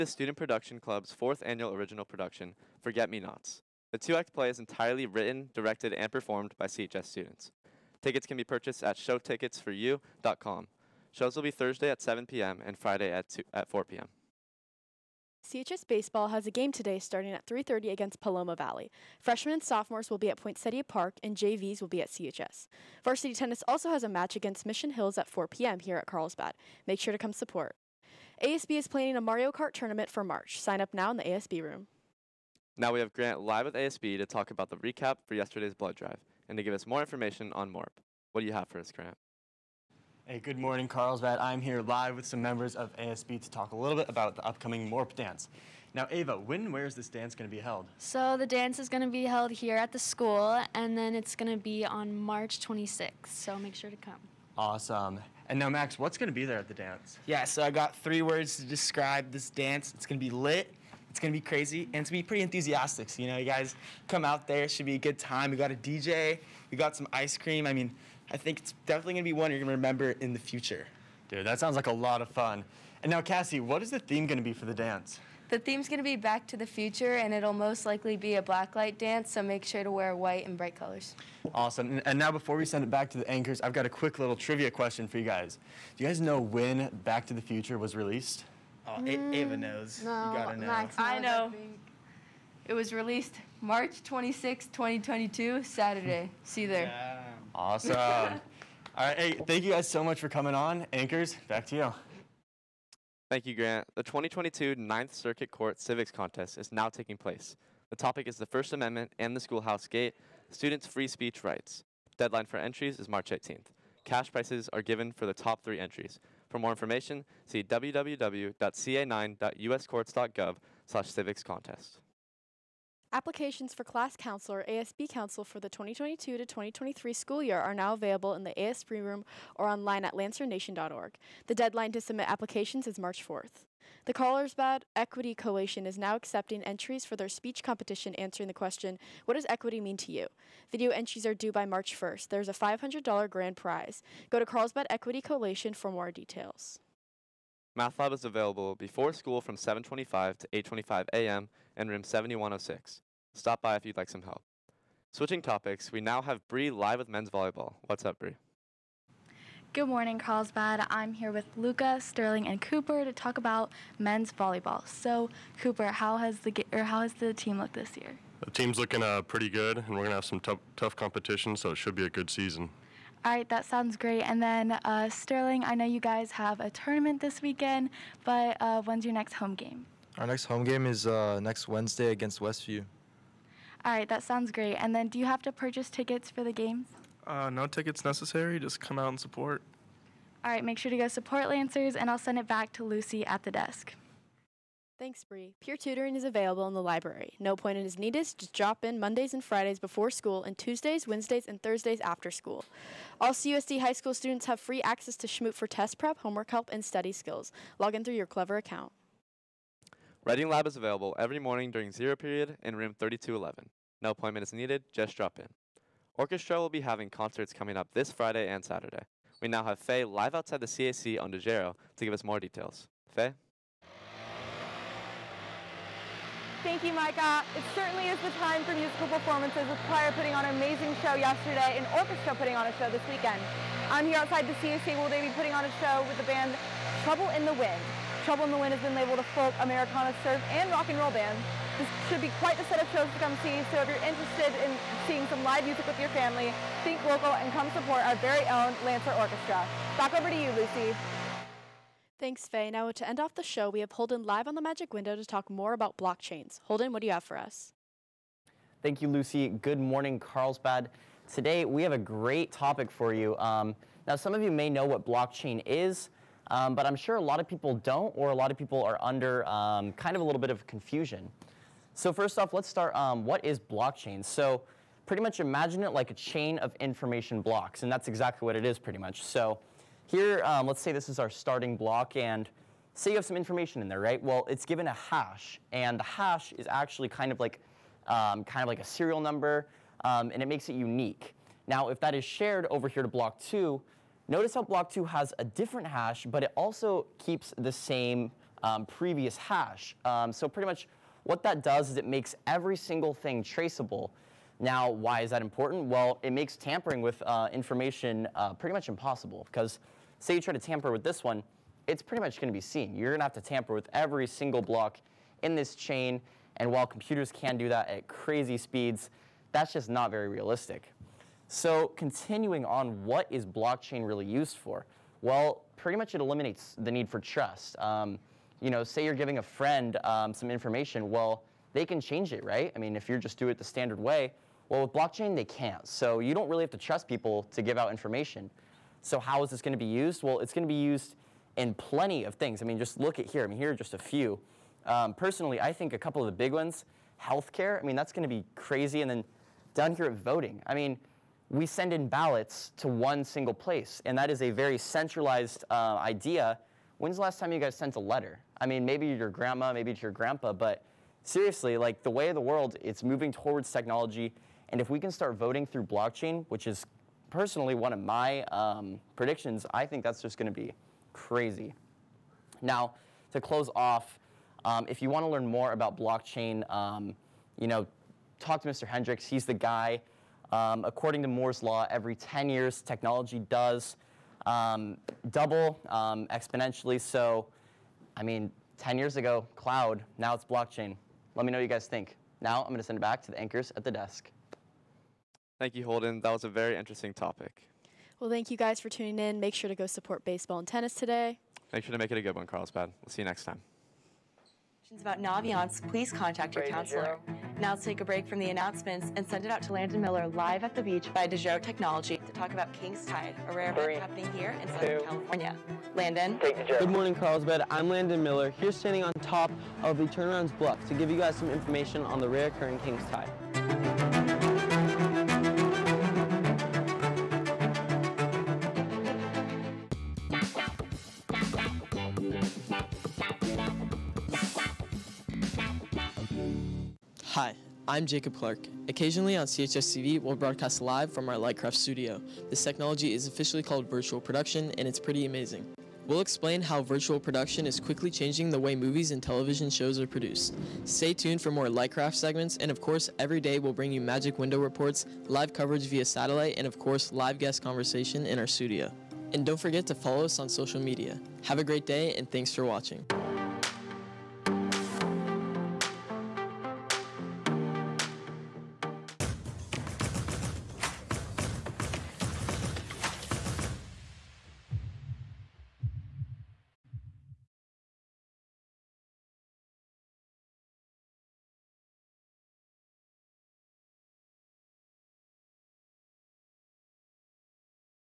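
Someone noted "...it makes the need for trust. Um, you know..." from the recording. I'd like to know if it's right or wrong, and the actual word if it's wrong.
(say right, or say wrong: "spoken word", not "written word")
wrong: "eliminates", not "makes".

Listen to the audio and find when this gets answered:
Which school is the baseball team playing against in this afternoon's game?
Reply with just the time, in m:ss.
0:18.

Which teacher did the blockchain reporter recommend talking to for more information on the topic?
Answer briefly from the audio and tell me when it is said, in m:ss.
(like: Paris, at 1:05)
Mr. Hendricks, at 6:18.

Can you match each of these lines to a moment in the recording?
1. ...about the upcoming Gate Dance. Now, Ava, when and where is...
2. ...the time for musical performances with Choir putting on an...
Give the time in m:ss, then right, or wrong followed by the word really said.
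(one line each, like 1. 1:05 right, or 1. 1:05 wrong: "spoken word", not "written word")
1. 0:44 wrong: "Morp", not "Gate"
2. 3:48 right.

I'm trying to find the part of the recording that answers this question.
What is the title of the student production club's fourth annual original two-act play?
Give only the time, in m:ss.
0:02.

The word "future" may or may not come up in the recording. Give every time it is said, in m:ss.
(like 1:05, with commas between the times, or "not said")
1:10, 1:16, 1:27.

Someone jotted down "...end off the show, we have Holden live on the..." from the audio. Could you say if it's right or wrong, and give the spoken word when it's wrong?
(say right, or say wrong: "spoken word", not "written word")
right.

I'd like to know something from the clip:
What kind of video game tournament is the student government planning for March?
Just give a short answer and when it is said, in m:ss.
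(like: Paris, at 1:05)
Mario Kart, at 0:29.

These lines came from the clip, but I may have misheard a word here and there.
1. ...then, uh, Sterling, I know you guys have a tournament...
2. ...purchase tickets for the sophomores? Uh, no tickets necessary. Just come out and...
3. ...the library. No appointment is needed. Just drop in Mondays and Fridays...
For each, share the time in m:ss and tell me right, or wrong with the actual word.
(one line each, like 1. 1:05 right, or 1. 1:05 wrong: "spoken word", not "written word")
1. 2:54 right
2. 3:05 wrong: "games", not "sophomores"
3. 3:16 right.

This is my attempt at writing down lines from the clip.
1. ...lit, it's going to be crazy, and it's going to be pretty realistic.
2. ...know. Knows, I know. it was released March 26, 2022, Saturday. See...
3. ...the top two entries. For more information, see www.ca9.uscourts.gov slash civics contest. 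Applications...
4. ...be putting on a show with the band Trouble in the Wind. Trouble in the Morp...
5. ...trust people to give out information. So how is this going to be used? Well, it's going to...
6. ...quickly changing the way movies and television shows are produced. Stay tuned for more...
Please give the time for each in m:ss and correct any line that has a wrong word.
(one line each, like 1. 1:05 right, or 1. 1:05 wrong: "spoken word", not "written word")
1. 1:00 wrong: "enthusiastic", not "realistic"
2. 1:30 right
3. 1:55 wrong: "three", not "two"
4. 3:55 wrong: "Wind", not "Morp"
5. 5:36 right
6. 7:27 right.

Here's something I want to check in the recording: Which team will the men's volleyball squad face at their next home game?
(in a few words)
Westview.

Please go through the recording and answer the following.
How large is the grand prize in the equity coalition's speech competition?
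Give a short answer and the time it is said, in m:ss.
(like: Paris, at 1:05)
$500, at 2:22.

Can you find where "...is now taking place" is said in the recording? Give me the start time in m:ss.
1:46.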